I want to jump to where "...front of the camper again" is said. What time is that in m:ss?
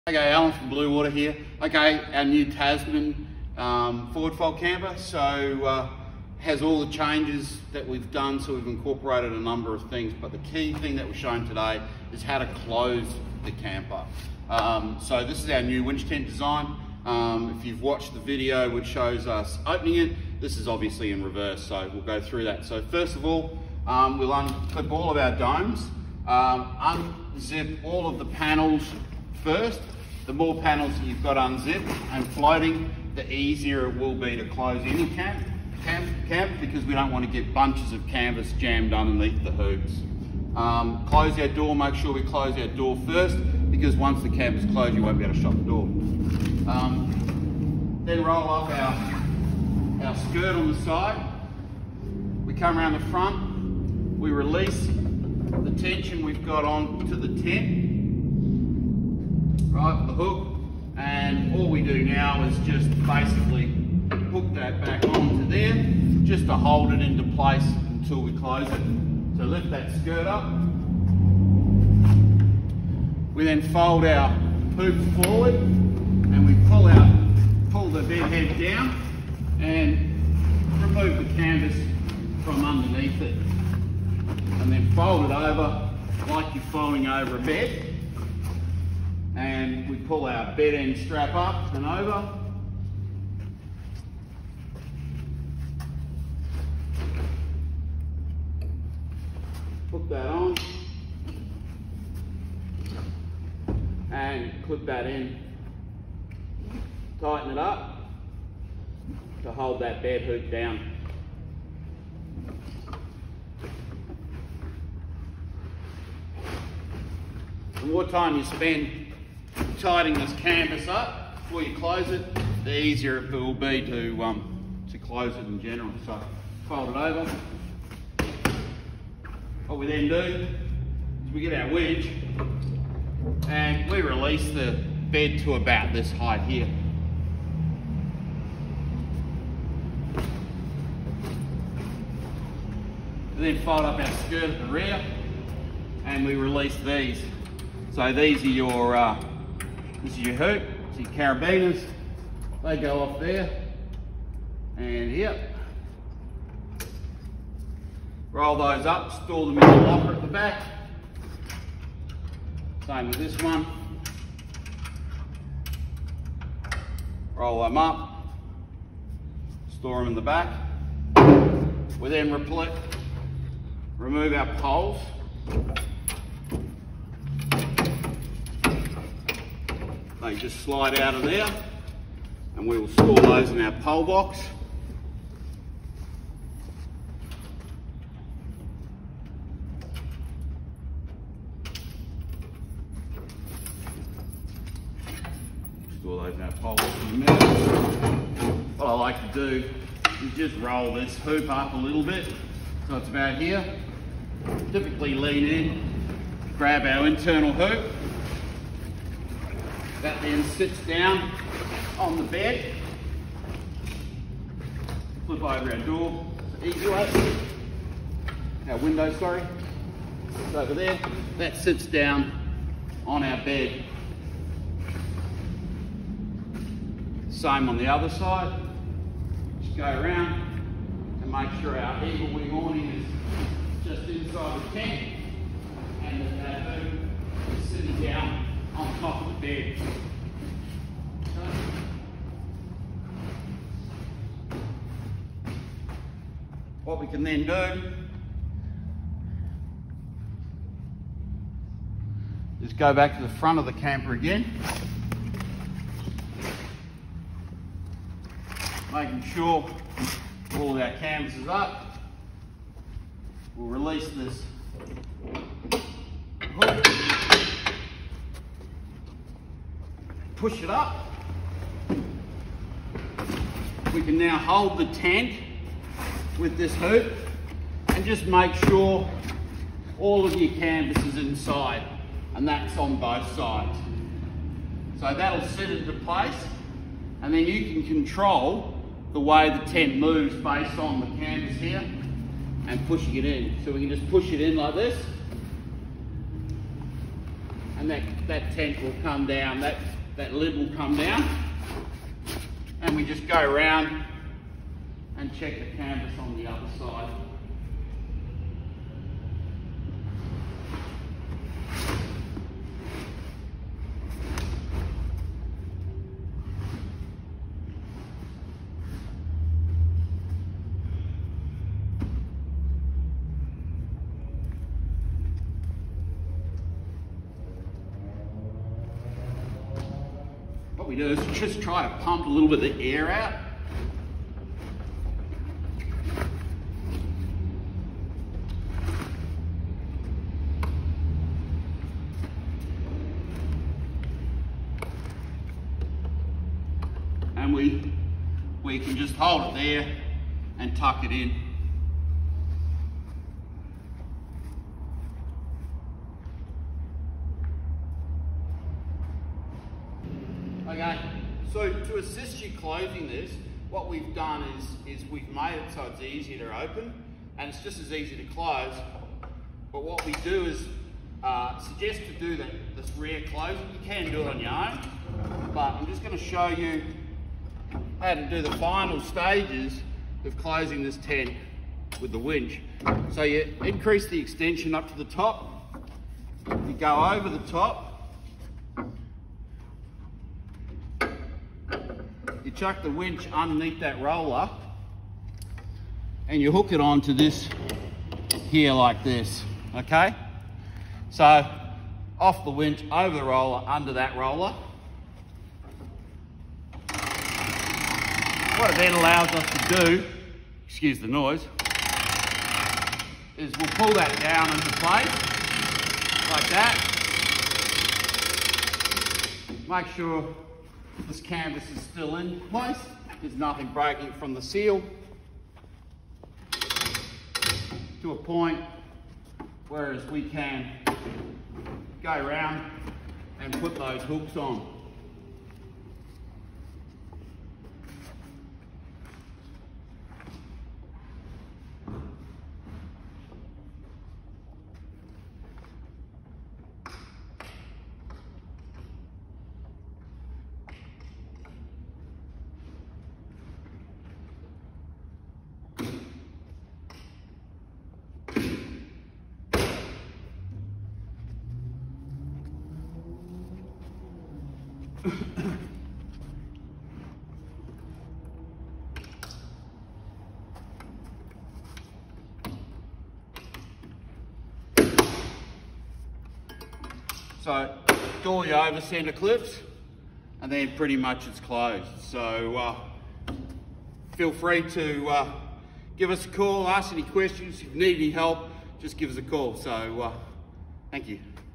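4:13.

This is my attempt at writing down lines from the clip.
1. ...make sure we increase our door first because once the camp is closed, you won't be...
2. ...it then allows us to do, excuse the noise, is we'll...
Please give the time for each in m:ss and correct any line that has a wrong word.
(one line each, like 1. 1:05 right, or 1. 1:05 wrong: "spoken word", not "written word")
1. 0:41 wrong: "close", not "increase"
2. 6:48 right.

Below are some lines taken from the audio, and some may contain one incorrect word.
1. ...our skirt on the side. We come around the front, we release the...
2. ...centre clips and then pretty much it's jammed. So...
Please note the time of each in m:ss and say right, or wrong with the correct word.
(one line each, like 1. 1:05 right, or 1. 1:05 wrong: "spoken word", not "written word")
1. 0:50 right
2. 7:58 wrong: "closed", not "jammed".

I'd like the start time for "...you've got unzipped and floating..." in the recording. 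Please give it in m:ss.
0:31.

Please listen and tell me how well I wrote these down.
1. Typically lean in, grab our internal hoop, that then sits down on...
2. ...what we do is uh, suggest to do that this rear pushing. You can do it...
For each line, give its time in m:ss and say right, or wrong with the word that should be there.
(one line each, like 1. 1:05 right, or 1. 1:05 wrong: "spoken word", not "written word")
1. 3:24 right
2. 6:09 wrong: "closing", not "pushing".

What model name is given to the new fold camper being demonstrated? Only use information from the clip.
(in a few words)
Tasman.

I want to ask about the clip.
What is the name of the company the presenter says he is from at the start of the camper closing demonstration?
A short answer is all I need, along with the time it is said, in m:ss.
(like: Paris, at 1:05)
Bluewater, at 0:00.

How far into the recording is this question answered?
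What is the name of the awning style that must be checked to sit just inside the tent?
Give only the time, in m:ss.
3:52.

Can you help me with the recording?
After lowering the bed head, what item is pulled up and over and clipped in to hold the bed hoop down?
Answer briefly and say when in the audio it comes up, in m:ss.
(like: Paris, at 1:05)
Bed end strap, at 1:30.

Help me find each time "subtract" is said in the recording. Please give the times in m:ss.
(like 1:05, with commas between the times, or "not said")
not said.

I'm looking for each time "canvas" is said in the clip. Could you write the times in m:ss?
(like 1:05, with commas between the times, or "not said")
0:38, 1:21, 2:00, 4:20, 4:40, 4:51, 5:05, 7:01.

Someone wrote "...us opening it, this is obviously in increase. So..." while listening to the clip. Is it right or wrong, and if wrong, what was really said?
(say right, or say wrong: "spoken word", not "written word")
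wrong: "reverse", not "increase".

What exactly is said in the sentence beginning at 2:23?
then fold up our skirt at the rear and we release these.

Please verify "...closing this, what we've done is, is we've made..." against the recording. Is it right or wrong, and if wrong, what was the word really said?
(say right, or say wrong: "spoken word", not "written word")
right.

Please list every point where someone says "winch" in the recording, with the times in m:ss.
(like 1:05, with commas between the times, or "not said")
0:15, 6:22, 6:32, 6:42.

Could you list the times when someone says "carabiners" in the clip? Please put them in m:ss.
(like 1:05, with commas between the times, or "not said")
2:31.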